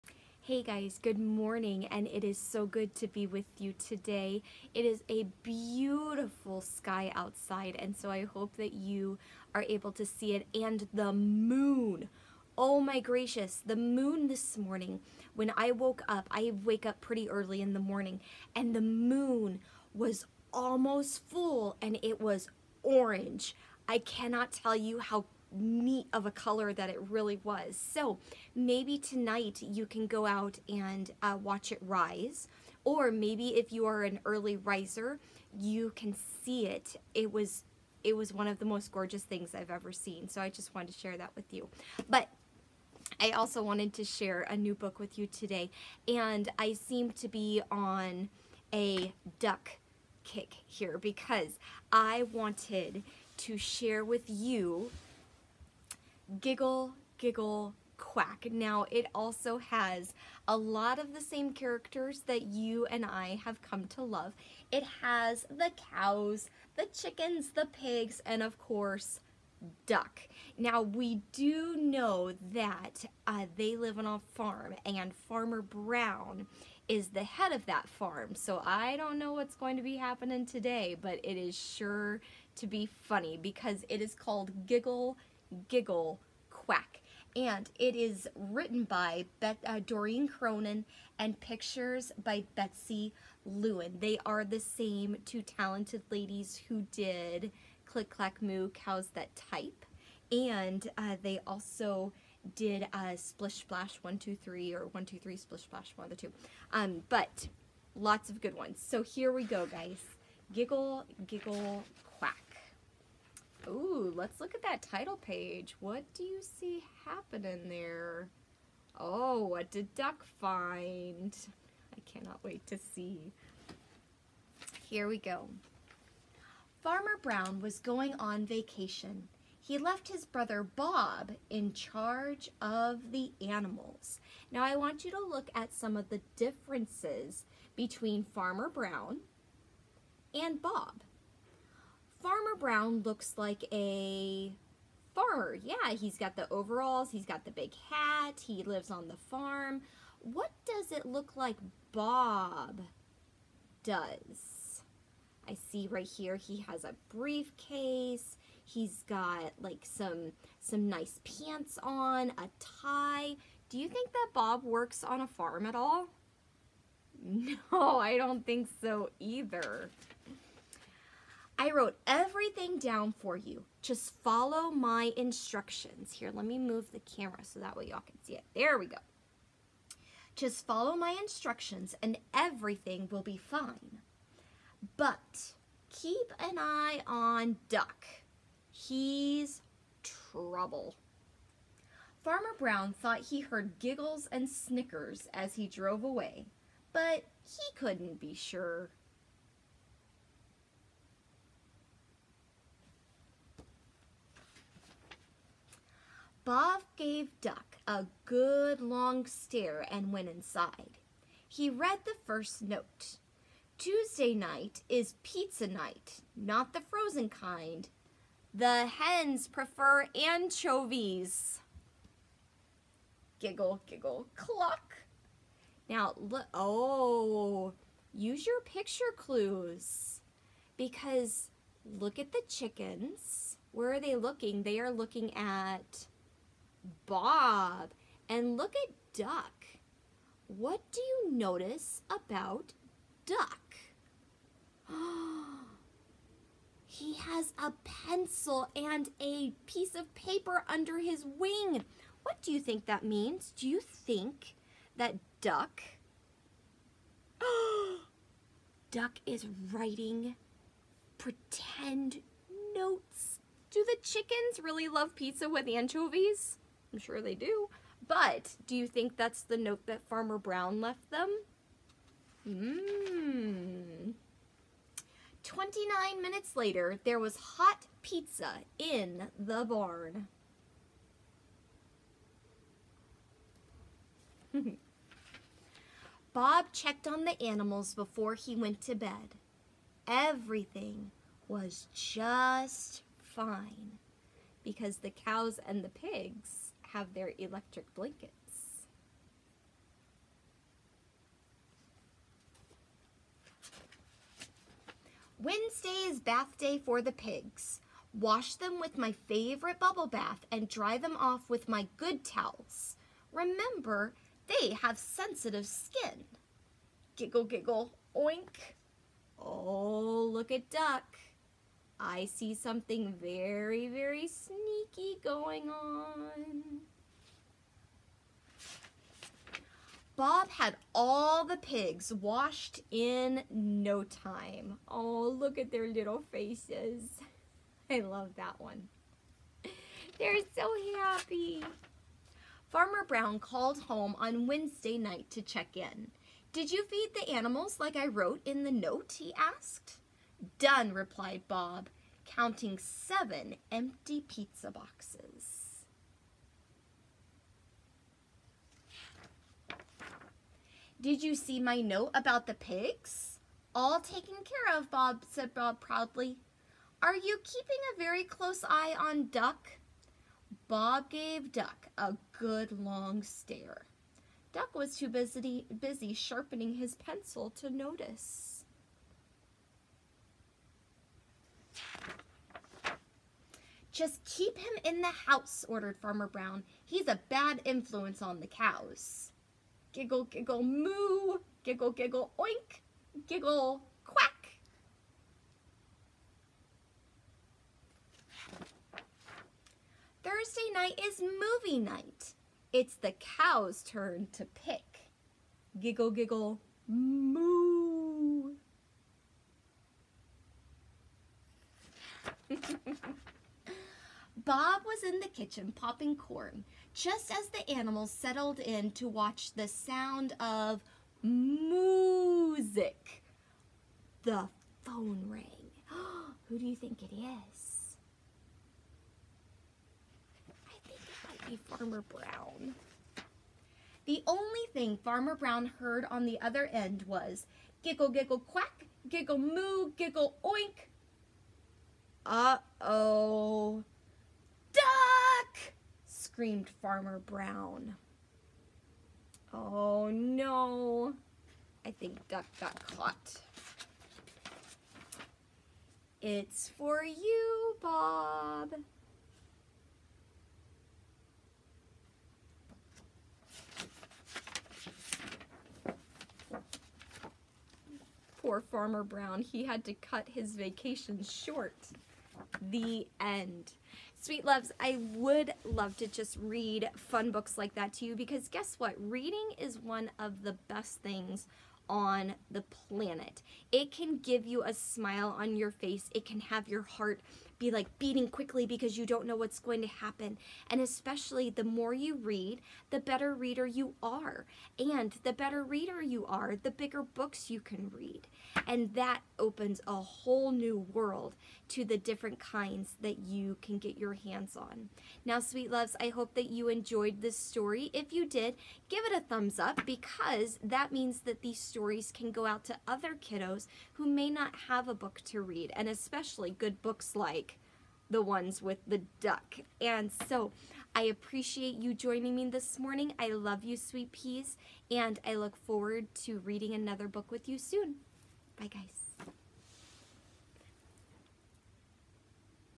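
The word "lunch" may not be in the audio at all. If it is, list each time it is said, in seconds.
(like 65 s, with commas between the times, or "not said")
not said.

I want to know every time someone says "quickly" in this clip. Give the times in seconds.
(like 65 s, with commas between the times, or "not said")
488 s.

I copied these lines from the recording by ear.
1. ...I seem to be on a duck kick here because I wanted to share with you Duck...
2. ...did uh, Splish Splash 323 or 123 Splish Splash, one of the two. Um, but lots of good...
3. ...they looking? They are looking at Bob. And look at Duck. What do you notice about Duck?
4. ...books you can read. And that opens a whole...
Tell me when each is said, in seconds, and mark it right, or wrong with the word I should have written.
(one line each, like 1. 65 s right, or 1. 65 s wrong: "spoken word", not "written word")
1. 46 s wrong: "Giggle", not "Duck"
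2. 102 s wrong: "123", not "323"
3. 233 s right
4. 497 s right.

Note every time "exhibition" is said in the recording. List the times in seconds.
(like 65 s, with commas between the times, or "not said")
not said.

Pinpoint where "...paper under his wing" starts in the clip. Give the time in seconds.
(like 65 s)
250 s.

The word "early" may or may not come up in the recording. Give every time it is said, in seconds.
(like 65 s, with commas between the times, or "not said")
17 s, 34 s.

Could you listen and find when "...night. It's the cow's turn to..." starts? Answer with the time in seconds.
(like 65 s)
401 s.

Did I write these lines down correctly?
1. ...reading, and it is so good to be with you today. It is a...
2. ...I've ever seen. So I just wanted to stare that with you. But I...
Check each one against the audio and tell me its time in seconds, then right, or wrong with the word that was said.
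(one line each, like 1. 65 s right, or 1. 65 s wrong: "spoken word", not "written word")
1. 1 s wrong: "morning", not "reading"
2. 39 s wrong: "share", not "stare".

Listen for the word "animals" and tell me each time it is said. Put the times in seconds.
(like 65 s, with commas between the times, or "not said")
133 s, 287 s, 347 s, 417 s.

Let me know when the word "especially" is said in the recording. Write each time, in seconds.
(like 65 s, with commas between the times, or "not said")
490 s, 515 s.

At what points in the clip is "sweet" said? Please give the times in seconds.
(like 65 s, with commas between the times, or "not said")
474 s, 505 s, 523 s.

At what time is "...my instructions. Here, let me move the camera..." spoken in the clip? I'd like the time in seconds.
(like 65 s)
174 s.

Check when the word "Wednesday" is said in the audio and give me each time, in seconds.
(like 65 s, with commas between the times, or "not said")
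305 s, 344 s.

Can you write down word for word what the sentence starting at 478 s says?
Reading is one of the best things on the planet.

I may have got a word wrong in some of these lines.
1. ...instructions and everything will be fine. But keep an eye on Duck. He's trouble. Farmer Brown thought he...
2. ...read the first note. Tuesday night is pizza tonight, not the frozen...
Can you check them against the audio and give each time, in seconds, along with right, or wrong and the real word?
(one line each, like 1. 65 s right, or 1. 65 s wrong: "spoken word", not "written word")
1. 181 s right
2. 211 s wrong: "night", not "tonight".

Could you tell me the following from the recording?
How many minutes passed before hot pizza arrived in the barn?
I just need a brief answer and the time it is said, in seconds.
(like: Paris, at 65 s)
29, at 275 s.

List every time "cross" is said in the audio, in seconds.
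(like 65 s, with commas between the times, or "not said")
not said.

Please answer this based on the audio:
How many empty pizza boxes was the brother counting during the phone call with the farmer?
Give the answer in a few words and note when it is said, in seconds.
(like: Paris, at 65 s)
7, at 352 s.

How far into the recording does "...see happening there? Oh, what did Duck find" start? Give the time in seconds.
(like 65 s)
116 s.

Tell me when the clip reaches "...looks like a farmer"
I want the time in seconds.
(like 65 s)
143 s.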